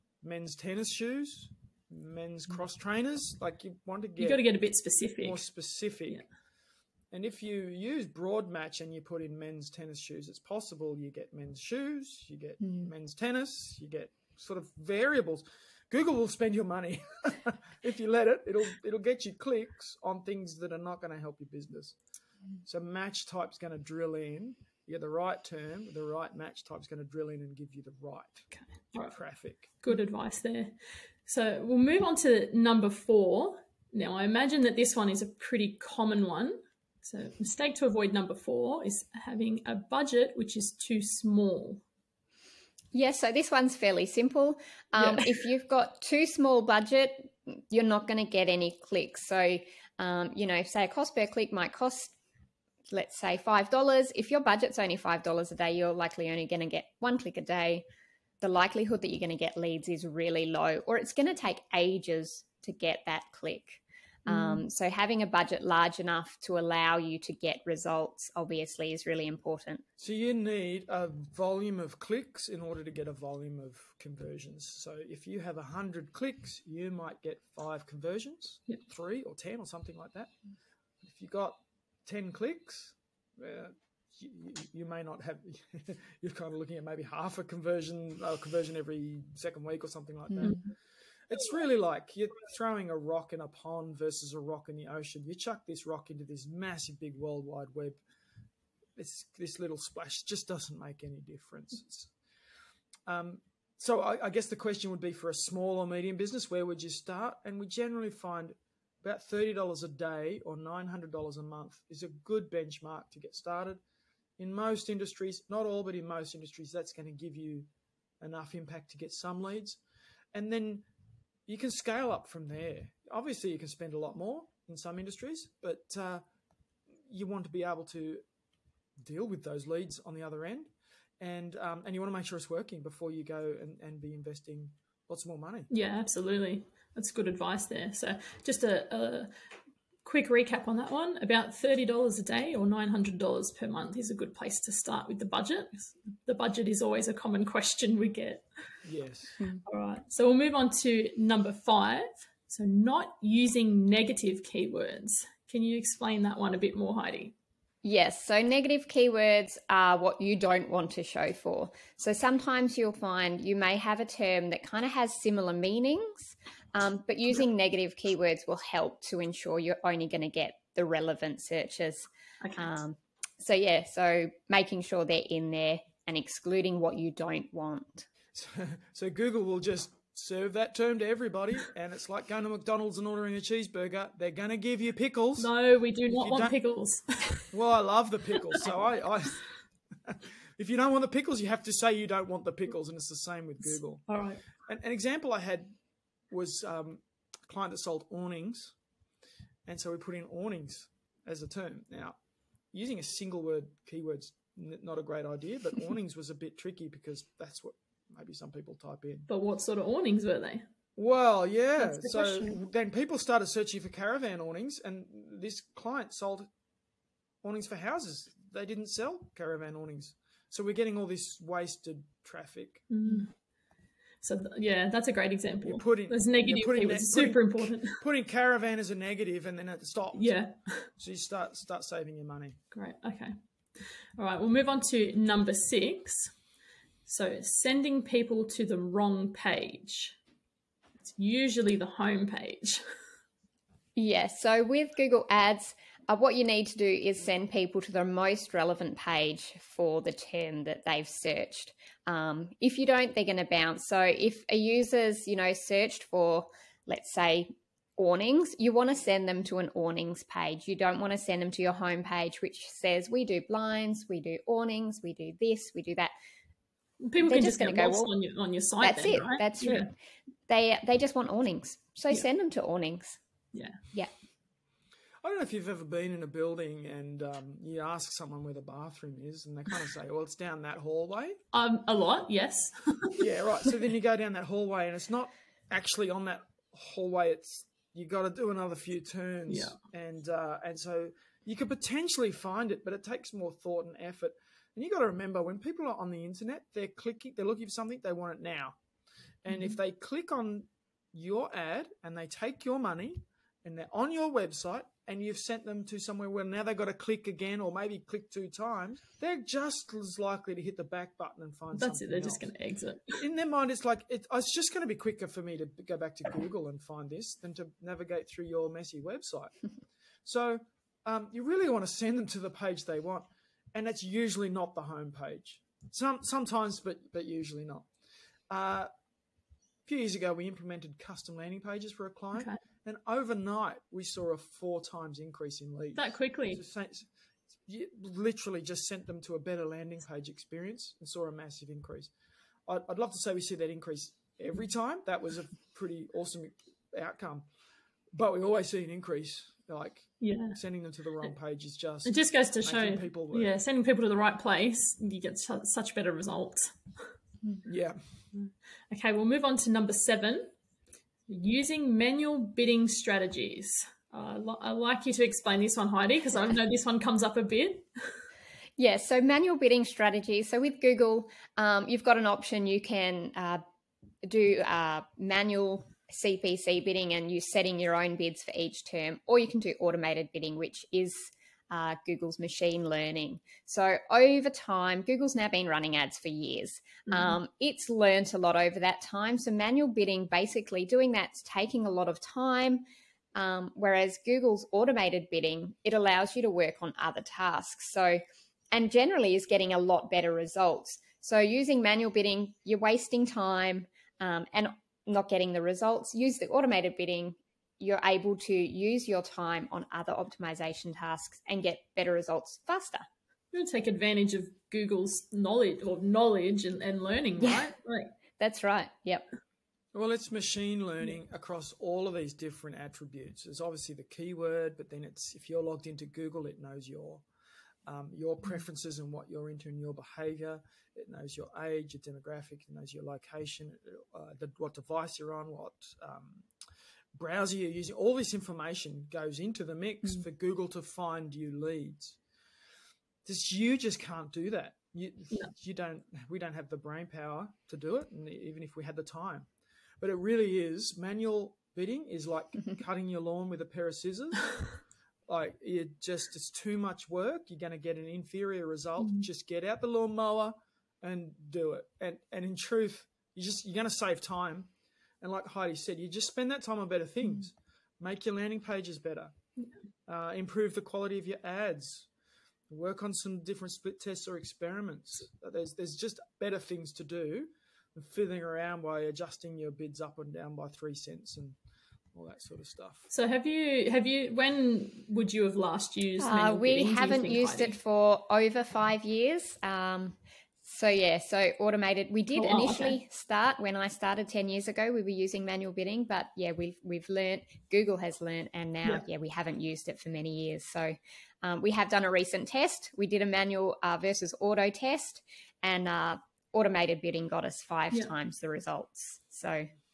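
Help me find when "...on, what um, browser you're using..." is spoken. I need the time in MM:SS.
07:15.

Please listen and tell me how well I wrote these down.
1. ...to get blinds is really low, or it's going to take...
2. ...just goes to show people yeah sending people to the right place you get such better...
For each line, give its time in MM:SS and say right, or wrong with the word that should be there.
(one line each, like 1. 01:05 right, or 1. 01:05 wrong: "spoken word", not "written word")
1. 00:59 wrong: "leads", not "blinds"
2. 05:52 right.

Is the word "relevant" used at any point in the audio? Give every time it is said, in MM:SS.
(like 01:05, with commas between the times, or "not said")
02:50, 04:08.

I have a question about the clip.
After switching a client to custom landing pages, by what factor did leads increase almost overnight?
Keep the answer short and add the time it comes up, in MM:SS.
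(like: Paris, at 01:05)
4 times, at 05:34.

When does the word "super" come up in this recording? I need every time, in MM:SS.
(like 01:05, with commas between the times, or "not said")
03:46.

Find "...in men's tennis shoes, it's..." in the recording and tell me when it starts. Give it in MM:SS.
00:09.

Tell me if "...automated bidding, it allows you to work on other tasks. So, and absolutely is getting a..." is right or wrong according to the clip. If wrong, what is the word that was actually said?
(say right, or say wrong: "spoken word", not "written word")
wrong: "generally", not "absolutely".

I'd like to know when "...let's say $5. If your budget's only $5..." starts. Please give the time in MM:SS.
00:52.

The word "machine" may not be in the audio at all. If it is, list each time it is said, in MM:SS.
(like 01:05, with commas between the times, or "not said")
06:22, 07:00.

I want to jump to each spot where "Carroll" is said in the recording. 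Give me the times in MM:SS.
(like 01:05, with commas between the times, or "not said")
not said.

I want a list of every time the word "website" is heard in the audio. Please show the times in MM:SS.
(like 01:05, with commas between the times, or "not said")
05:04, 05:19.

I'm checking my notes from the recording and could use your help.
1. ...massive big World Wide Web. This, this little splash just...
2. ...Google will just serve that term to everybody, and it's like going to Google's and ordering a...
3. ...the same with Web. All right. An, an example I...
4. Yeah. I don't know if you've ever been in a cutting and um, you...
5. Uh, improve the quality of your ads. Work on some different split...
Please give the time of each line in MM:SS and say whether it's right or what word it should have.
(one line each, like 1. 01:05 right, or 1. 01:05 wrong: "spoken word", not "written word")
1. 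01:36 right
2. 02:59 wrong: "McDonald", not "Google"
3. 03:13 wrong: "Google", not "Web"
4. 04:33 wrong: "building", not "cutting"
5. 07:50 right.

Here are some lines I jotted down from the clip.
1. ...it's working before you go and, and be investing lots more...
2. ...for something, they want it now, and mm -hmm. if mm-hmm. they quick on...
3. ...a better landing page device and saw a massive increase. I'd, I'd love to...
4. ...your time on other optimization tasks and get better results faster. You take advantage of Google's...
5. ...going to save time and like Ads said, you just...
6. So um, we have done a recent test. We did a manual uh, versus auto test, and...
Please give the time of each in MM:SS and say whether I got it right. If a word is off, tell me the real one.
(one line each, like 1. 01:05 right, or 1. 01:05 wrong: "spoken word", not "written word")
1. 02:12 right
2. 04:57 wrong: "click", not "quick"
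3. 05:39 wrong: "experience", not "device"
4. 06:49 right
5. 07:43 wrong: "Heidi", not "Ads"
6. 08:20 right.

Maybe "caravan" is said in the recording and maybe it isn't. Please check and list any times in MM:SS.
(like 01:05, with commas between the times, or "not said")
03:33, 03:39, 03:48.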